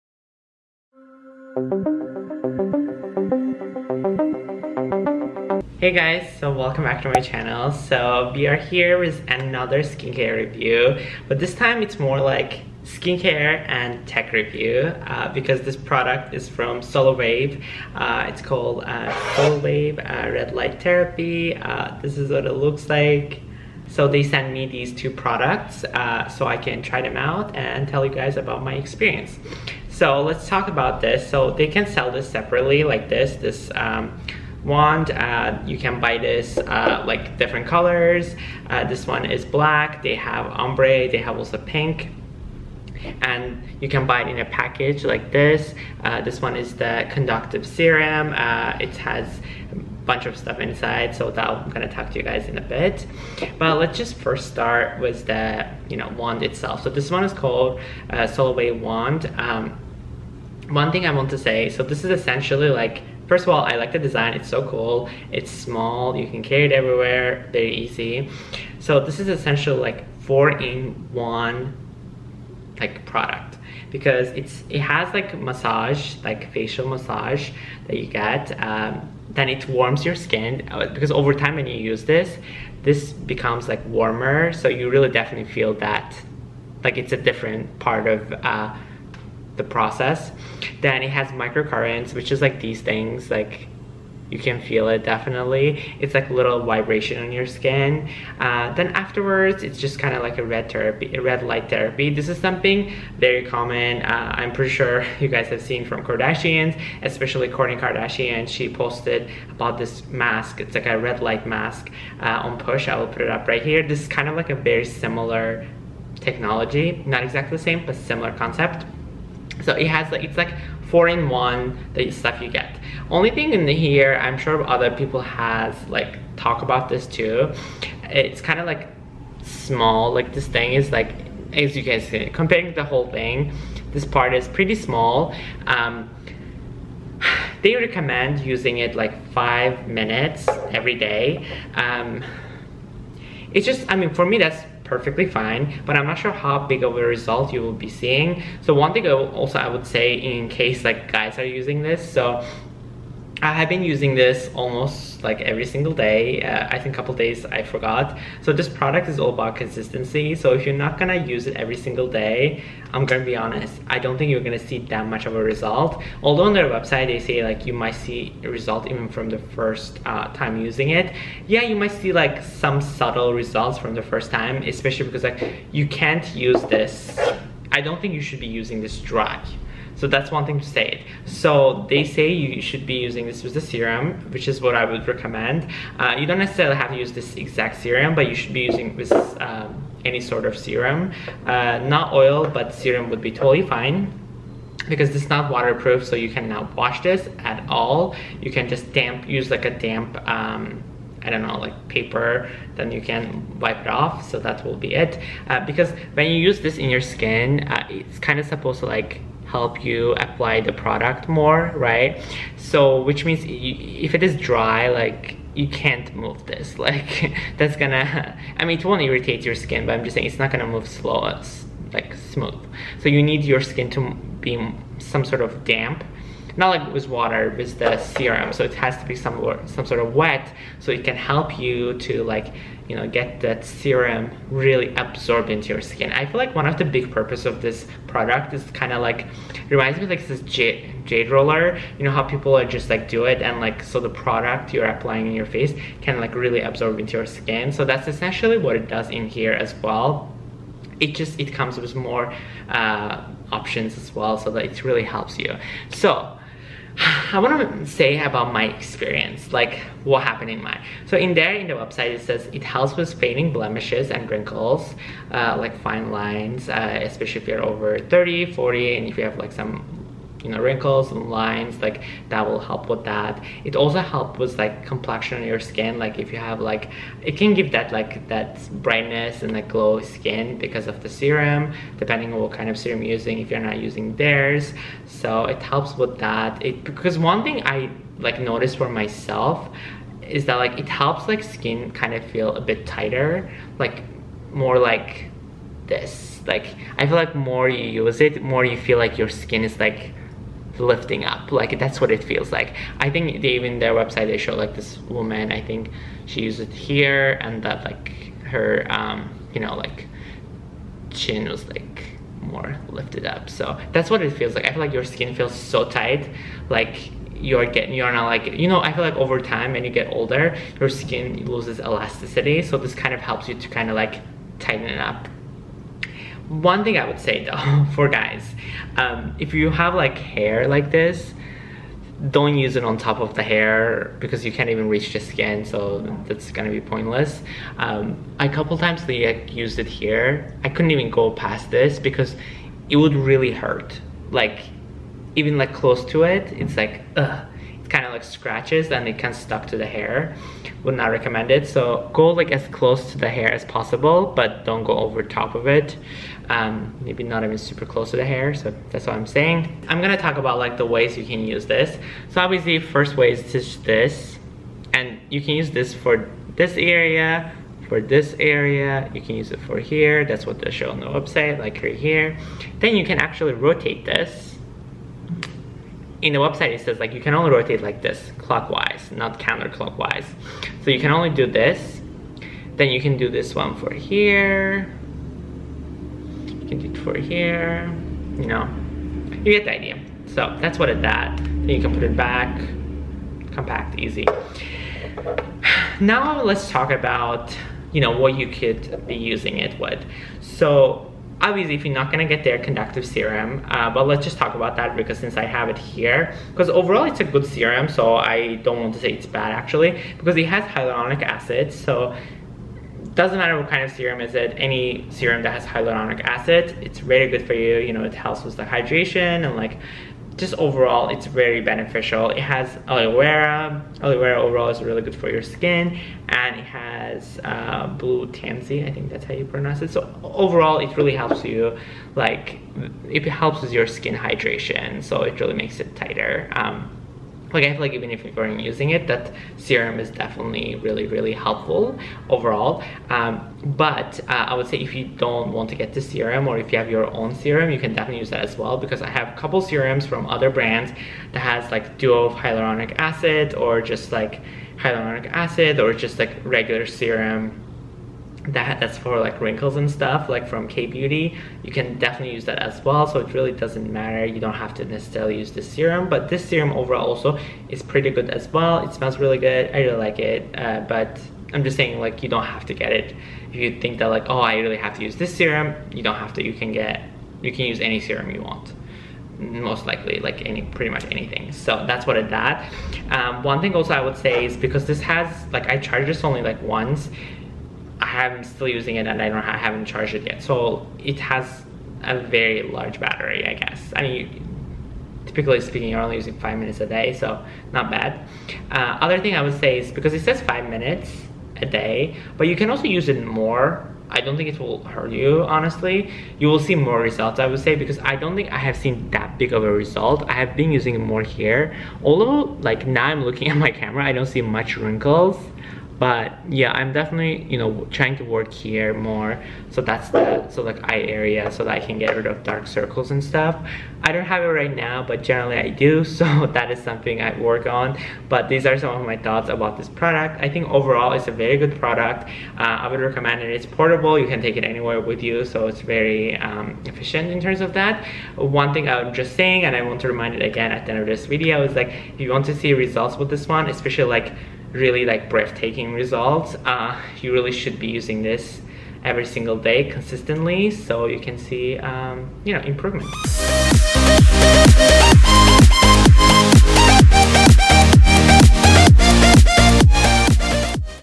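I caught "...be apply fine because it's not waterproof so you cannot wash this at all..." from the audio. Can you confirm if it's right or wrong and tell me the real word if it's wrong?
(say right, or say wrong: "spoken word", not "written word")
wrong: "totally", not "apply".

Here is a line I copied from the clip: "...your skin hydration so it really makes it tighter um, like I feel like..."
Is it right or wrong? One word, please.
right.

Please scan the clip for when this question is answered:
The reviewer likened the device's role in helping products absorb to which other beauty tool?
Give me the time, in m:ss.
4:01.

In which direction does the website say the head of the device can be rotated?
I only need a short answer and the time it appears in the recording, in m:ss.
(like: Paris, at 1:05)
clockwise, at 6:18.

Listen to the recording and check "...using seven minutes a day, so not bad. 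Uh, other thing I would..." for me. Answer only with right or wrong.
wrong.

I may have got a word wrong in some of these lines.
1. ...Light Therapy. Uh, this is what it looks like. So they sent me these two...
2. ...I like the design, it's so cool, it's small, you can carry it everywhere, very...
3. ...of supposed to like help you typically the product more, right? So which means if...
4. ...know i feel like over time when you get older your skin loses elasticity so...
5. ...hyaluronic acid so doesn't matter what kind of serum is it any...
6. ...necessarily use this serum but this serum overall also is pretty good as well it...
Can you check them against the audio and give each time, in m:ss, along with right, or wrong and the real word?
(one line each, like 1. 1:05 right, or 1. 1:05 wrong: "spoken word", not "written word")
1. 0:20 right
2. 1:03 right
3. 3:28 wrong: "apply", not "typically"
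4. 5:18 right
5. 6:50 right
6. 7:44 right.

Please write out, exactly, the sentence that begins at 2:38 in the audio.
So this product is all about consistency.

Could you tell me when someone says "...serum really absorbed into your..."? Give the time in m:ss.
3:53.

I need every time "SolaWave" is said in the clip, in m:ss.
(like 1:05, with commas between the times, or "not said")
0:16, 0:58.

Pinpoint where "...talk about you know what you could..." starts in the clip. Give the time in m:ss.
6:36.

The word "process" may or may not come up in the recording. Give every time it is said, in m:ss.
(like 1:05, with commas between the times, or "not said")
1:29.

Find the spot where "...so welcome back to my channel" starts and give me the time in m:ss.
0:06.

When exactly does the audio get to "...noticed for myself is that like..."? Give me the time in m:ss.
4:48.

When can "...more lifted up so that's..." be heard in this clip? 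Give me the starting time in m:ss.
5:12.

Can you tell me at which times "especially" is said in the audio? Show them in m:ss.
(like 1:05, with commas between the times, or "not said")
1:47, 2:54, 4:27, 9:03.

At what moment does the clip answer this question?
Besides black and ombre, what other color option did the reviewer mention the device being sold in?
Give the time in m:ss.
0:41.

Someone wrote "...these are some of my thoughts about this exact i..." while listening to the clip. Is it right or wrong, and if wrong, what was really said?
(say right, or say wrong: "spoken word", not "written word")
wrong: "product", not "exact".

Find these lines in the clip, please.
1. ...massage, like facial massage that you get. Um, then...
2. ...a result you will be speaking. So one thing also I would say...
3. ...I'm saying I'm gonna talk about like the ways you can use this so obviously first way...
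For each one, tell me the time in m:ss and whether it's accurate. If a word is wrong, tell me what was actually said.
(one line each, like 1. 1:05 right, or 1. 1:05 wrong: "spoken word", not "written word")
1. 1:15 right
2. 2:26 wrong: "seeing", not "speaking"
3. 5:59 right.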